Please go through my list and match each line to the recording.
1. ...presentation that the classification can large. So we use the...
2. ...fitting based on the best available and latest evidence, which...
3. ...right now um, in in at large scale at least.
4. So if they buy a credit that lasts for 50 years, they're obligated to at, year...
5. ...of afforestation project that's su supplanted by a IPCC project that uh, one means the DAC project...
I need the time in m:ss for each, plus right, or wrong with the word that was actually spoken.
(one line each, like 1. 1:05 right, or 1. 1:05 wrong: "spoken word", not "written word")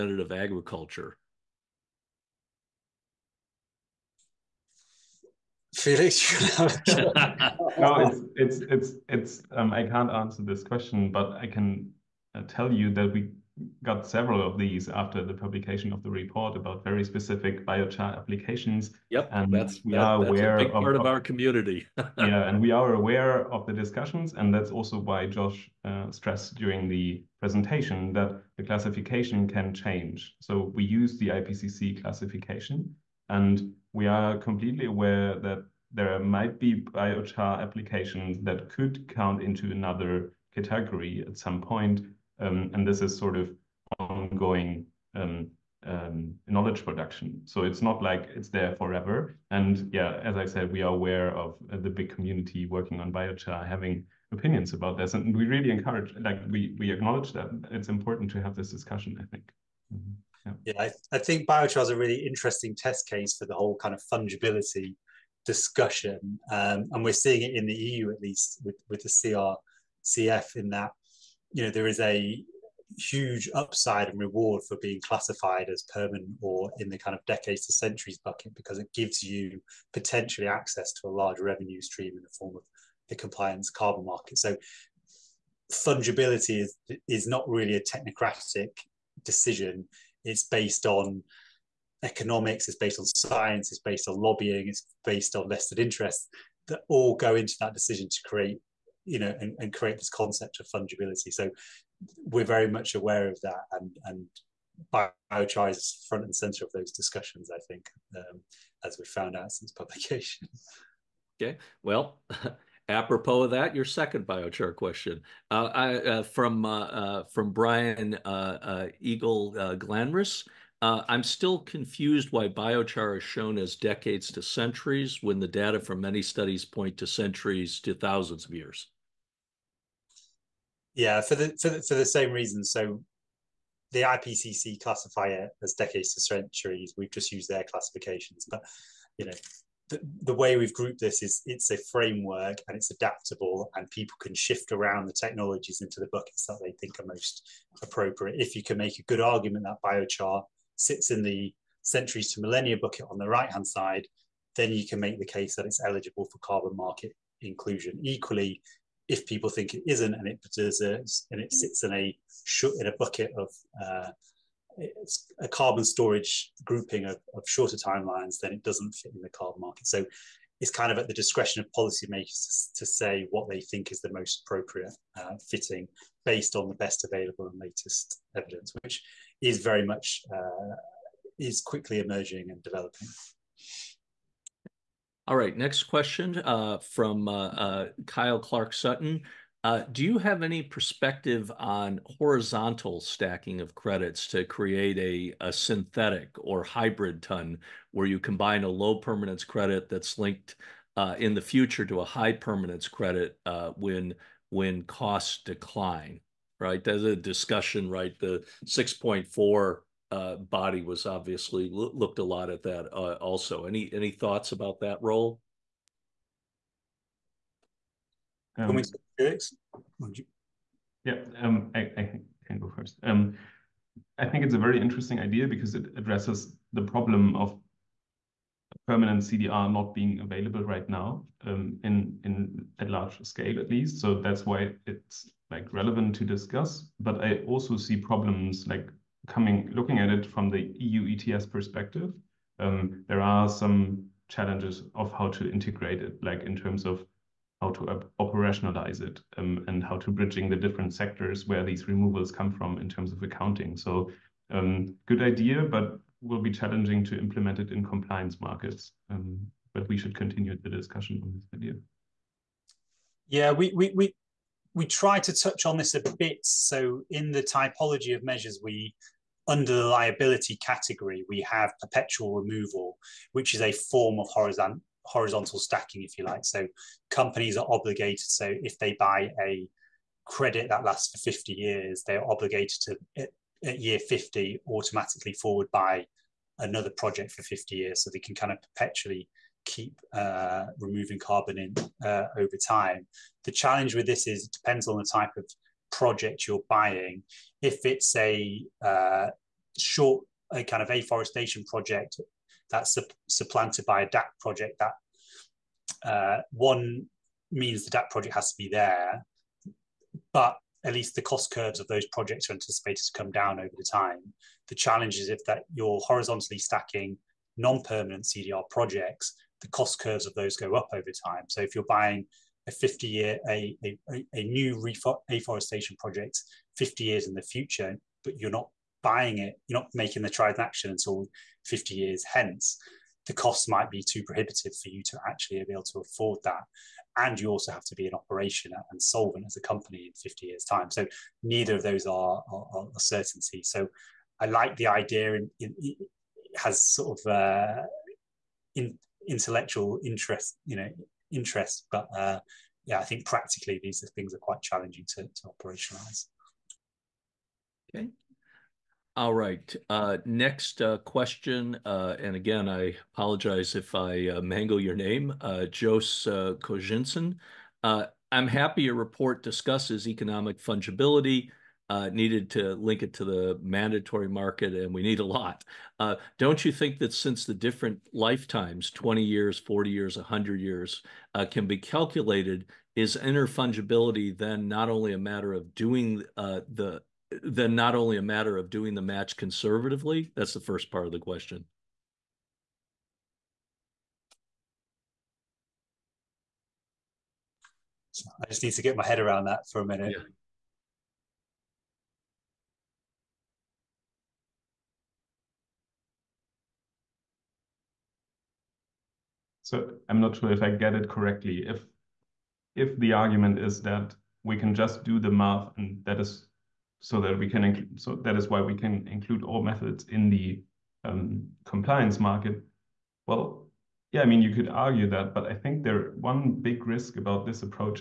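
1. 0:27 wrong: "change", not "large"
2. 2:55 right
3. 3:50 right
4. 4:38 right
5. 5:00 wrong: "DAC", not "IPCC".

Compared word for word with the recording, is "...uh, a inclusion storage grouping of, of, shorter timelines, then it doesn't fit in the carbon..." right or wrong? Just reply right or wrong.
wrong.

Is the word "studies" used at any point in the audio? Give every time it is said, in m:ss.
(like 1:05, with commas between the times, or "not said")
2:06.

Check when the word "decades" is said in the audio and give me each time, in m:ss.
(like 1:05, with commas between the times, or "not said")
1:17, 2:03, 2:15.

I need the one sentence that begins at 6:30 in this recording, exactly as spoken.
That's the first part of the question.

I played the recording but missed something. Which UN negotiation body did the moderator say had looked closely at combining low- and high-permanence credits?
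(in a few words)
6.4 body.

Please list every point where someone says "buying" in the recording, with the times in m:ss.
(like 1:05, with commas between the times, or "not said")
4:56, 5:21, 5:29.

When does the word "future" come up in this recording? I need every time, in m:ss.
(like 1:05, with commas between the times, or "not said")
3:21, 5:27.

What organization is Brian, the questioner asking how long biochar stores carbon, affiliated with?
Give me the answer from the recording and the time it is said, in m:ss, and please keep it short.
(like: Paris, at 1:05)
Glanris, at 1:59.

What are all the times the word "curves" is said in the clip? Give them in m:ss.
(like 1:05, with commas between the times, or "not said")
5:11, 5:19.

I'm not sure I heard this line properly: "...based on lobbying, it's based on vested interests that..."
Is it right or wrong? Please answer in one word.
right.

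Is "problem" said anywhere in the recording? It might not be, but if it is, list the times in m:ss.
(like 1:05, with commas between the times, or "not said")
3:46, 3:57.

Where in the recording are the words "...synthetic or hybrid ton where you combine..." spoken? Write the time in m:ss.
3:15.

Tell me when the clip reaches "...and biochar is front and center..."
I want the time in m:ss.
1:44.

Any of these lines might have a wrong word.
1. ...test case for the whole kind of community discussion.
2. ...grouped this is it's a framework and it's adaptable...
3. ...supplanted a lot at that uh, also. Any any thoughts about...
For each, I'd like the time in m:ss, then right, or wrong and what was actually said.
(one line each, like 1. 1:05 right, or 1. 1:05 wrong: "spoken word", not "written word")
1. 1:02 wrong: "fungibility", not "community"
2. 2:20 right
3. 3:31 wrong: "looked", not "supplanted".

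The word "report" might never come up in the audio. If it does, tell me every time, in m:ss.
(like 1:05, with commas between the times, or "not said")
0:16, 6:08.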